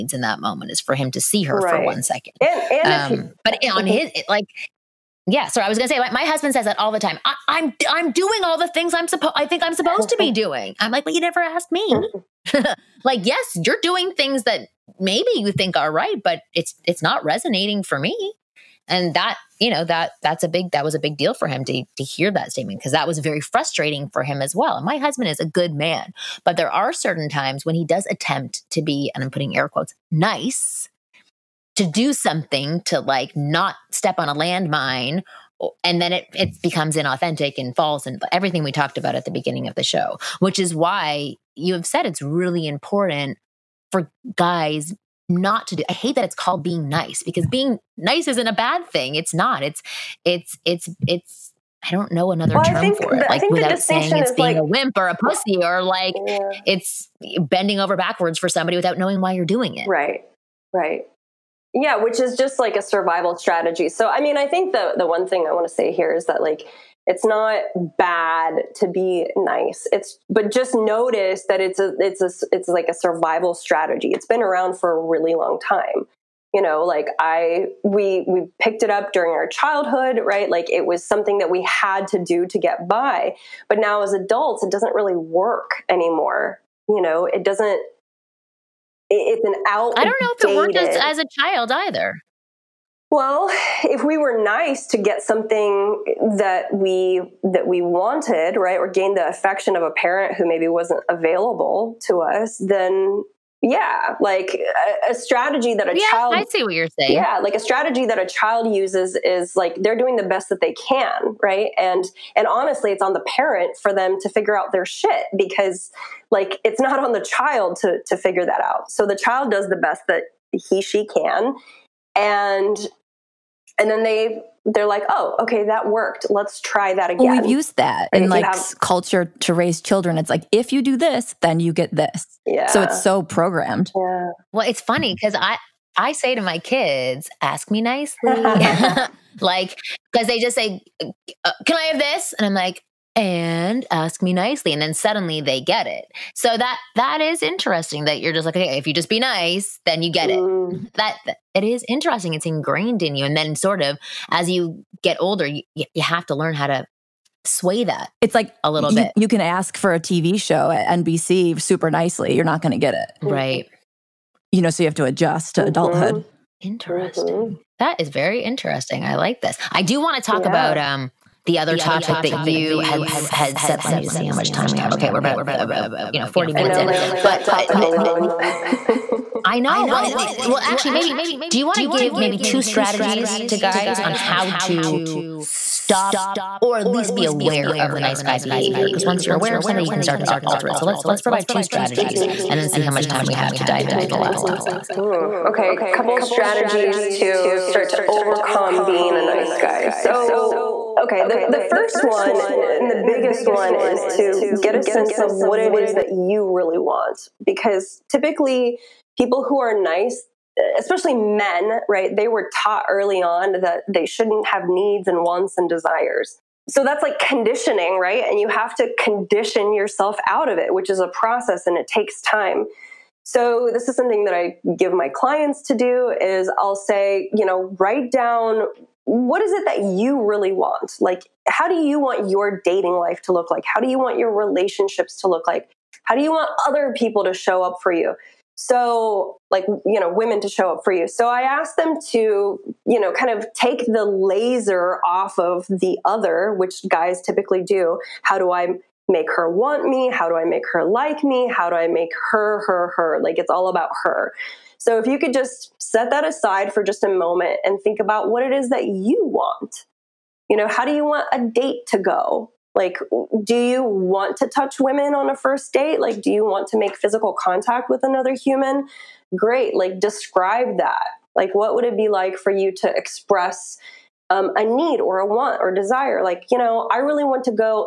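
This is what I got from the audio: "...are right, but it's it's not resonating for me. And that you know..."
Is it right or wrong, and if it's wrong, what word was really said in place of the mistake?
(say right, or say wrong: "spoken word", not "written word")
right.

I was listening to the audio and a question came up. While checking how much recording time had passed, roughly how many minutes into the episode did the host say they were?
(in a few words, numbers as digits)
40 minutes.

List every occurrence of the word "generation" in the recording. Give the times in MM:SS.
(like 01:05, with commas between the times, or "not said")
not said.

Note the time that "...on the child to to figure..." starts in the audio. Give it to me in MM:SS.
01:57.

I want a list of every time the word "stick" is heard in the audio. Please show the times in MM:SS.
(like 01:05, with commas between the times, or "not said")
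not said.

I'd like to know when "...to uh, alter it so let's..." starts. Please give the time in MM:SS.
03:10.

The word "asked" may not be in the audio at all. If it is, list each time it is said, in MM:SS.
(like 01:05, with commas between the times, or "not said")
00:11, 04:01.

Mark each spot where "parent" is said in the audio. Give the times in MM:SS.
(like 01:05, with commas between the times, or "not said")
01:39, 01:53.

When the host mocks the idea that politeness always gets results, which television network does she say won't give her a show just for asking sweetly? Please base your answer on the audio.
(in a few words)
NBC.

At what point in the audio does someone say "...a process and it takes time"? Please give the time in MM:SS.
03:40.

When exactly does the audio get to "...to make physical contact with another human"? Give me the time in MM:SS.
04:26.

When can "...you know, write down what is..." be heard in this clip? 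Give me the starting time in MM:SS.
03:47.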